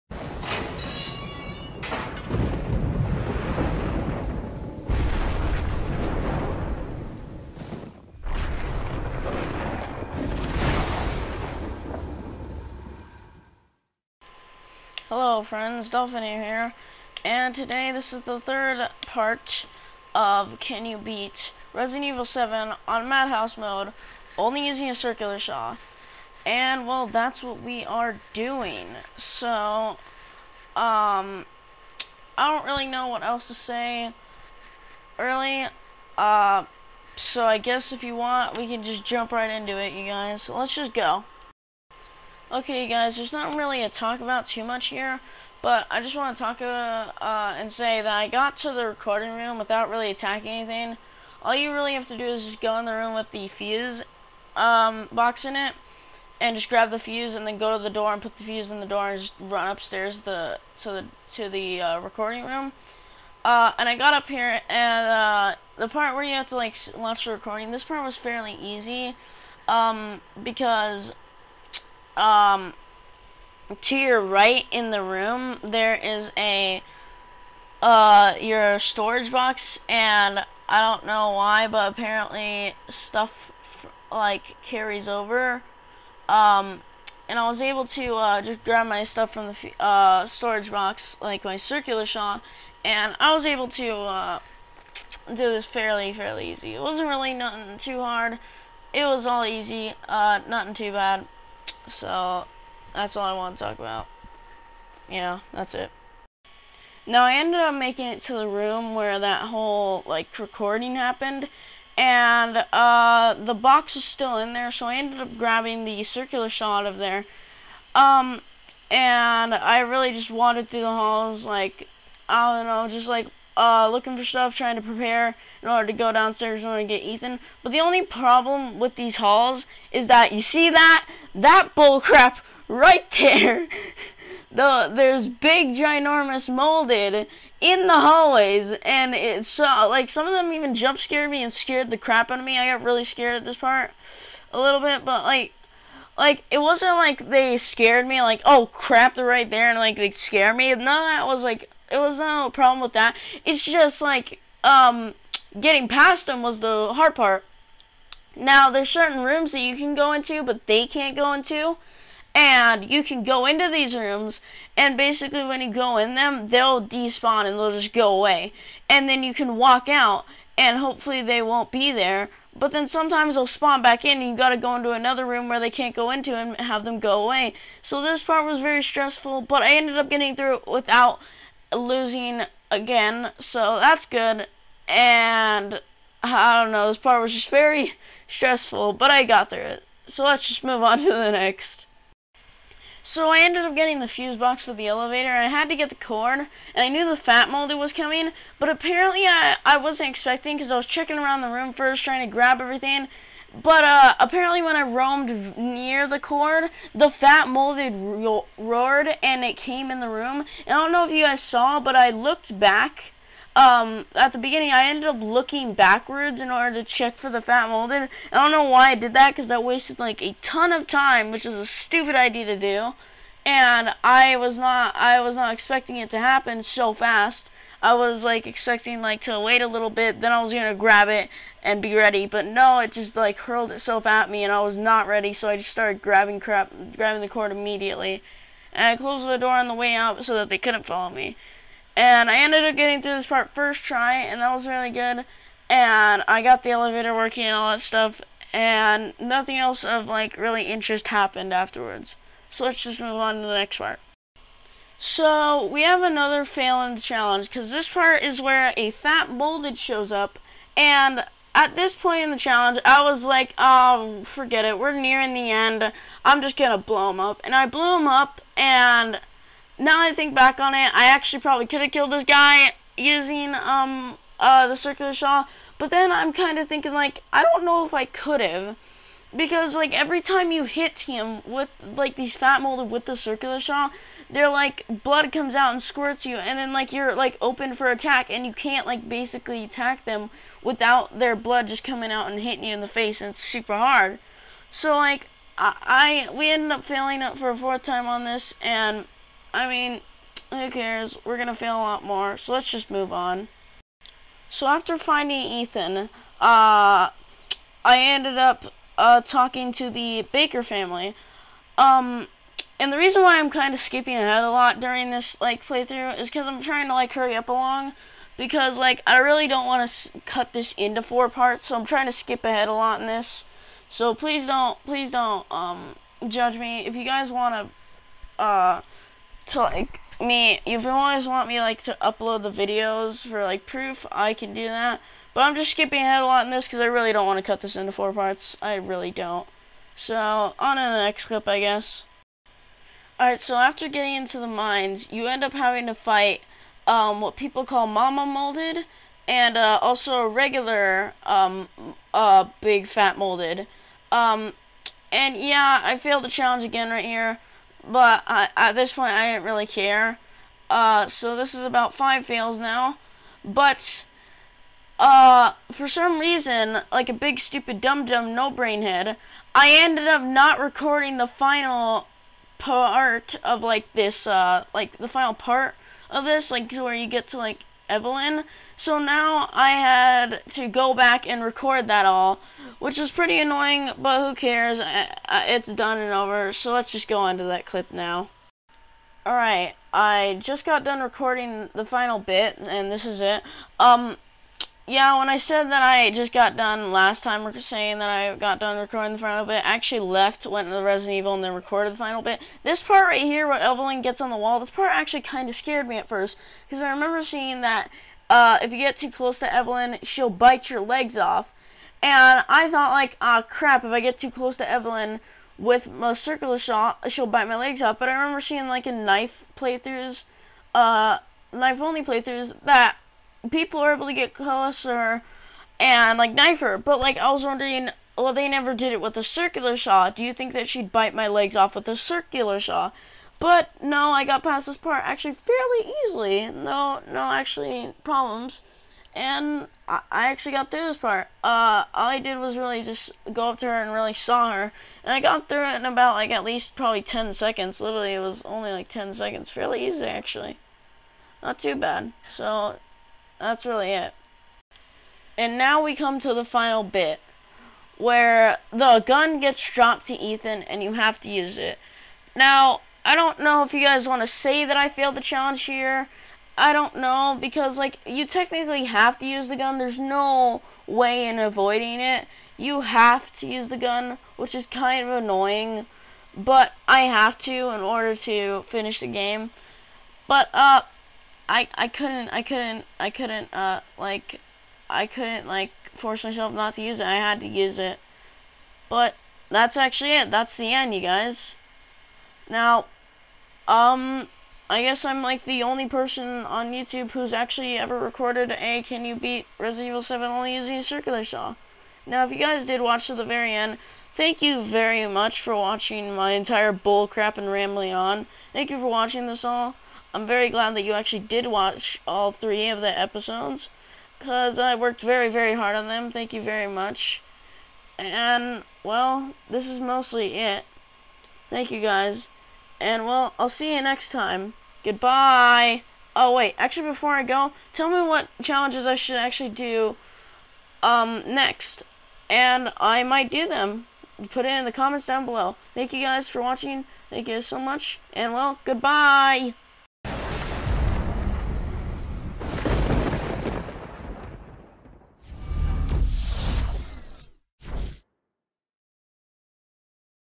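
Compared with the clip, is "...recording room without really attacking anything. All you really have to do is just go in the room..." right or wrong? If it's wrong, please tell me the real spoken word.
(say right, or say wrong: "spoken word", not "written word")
right.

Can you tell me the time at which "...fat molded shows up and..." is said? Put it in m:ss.
4:18.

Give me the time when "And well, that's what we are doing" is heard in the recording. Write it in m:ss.
0:26.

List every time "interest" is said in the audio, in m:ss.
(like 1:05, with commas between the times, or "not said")
4:10.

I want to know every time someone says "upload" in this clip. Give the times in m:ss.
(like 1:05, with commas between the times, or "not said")
5:32.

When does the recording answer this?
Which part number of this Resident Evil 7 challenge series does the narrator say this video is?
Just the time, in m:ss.
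0:18.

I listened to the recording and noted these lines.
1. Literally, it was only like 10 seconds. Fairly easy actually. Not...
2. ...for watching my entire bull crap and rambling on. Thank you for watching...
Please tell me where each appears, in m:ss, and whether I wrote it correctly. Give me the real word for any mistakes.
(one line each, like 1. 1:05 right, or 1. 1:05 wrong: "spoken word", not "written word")
1. 7:27 right
2. 8:25 right.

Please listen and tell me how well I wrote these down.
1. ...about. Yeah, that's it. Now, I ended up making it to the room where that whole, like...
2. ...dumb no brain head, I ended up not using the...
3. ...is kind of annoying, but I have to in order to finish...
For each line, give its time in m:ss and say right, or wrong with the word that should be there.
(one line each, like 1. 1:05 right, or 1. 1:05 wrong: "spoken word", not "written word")
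1. 1:43 right
2. 6:08 wrong: "recording", not "using"
3. 7:54 right.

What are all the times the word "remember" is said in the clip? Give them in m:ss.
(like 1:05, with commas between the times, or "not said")
6:46, 6:58.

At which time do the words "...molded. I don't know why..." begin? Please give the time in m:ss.
3:37.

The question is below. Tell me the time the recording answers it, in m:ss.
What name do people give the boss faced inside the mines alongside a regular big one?
5:47.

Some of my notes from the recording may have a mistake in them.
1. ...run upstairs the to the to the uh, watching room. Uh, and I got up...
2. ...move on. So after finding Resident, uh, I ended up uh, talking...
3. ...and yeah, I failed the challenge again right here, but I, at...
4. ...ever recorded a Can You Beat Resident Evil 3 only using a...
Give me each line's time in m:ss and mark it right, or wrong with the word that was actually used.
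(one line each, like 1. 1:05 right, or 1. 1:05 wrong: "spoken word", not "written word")
1. 0:59 wrong: "recording", not "watching"
2. 5:02 wrong: "Ethan", not "Resident"
3. 5:55 right
4. 8:17 wrong: "7", not "3".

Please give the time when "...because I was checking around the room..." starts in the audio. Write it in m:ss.
3:20.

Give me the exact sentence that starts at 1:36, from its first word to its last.
It wasn't really nothing too hard.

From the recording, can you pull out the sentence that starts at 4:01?
And I ended up getting through this part first try, and that was really good.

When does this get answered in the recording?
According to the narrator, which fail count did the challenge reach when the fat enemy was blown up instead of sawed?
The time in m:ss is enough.
4:57.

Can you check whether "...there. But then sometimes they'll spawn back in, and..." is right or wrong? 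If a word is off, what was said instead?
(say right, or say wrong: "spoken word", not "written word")
right.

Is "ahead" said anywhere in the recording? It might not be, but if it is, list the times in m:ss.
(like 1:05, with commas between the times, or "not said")
5:14, 5:22, 5:36.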